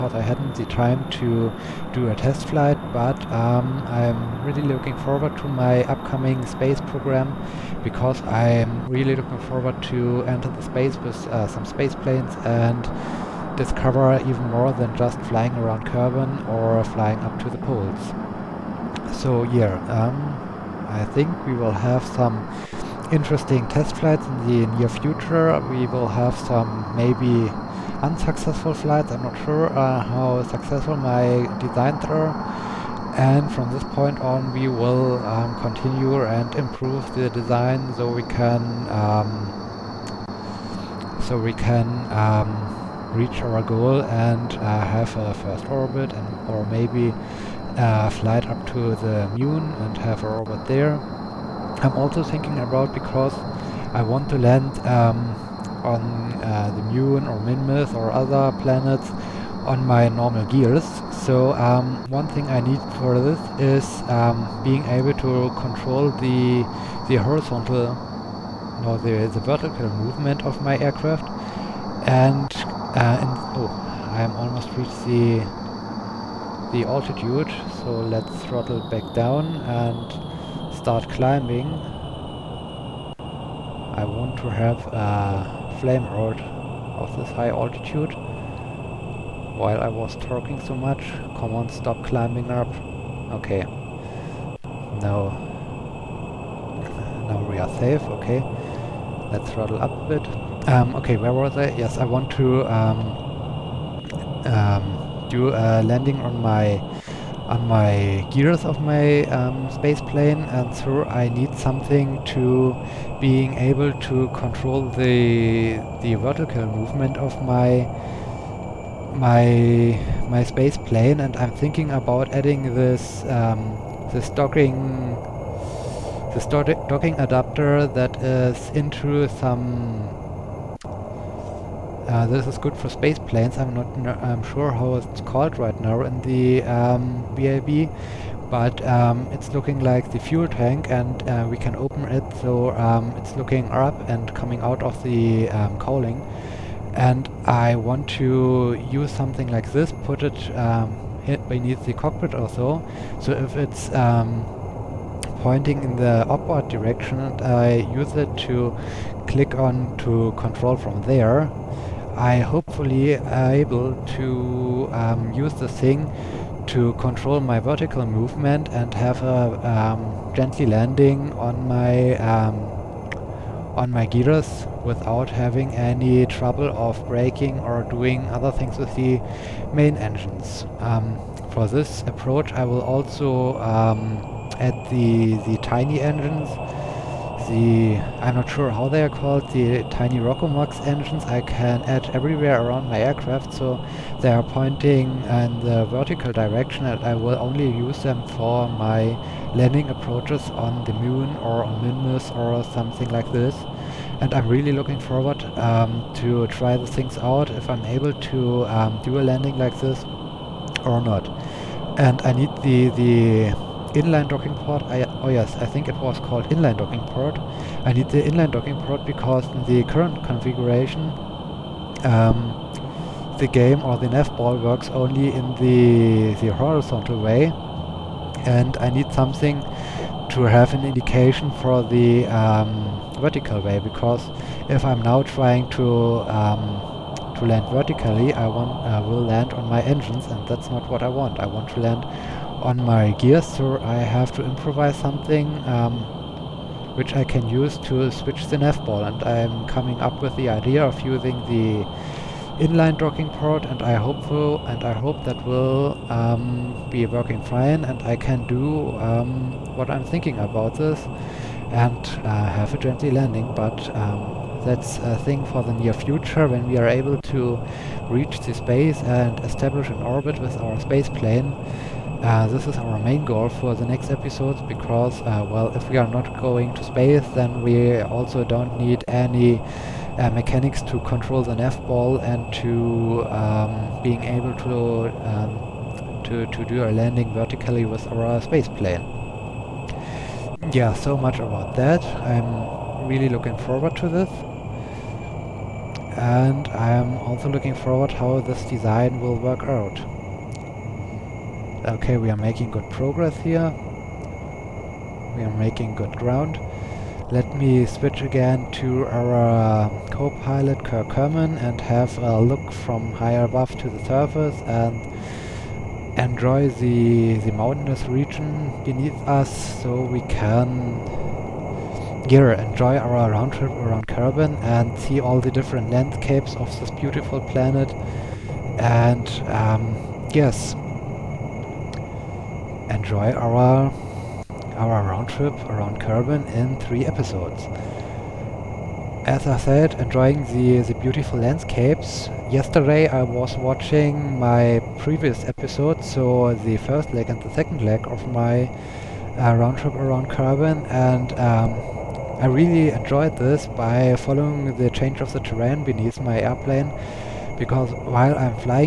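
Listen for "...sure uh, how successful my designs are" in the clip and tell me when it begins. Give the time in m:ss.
0:29.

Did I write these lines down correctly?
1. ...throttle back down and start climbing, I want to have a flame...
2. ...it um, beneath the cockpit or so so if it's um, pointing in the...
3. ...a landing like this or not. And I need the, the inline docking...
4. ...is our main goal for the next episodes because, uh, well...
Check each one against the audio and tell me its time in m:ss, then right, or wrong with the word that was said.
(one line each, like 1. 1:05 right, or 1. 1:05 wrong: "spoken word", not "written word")
1. 1:18 right
2. 2:30 right
3. 3:29 right
4. 4:32 right.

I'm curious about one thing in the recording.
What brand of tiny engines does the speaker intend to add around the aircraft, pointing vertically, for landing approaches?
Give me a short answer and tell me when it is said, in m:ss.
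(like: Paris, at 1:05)
Rockomax, at 3:10.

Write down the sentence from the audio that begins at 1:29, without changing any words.
While I was talking so much, come on, stop climbing up.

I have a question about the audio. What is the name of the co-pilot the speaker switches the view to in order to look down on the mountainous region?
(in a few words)
Kirk Herman.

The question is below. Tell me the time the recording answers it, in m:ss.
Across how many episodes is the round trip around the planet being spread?
5:36.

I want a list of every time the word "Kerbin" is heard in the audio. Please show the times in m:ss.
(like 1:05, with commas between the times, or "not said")
0:15, 5:24, 5:35, 5:50.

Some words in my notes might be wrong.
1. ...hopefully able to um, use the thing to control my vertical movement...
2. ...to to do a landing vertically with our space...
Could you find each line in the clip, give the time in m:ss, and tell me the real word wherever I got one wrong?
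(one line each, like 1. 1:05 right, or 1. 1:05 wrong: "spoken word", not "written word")
1. 2:42 right
2. 4:46 right.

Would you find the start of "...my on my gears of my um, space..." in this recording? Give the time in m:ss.
1:46.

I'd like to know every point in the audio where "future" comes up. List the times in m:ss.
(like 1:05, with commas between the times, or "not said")
0:24, 4:25.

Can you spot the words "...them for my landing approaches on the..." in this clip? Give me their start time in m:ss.
3:18.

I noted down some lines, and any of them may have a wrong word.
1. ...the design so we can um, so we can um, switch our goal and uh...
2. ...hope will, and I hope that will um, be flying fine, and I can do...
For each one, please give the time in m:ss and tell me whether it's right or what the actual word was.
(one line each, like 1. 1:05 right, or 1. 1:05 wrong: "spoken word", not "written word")
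1. 0:37 wrong: "reach", not "switch"
2. 4:13 wrong: "working", not "flying".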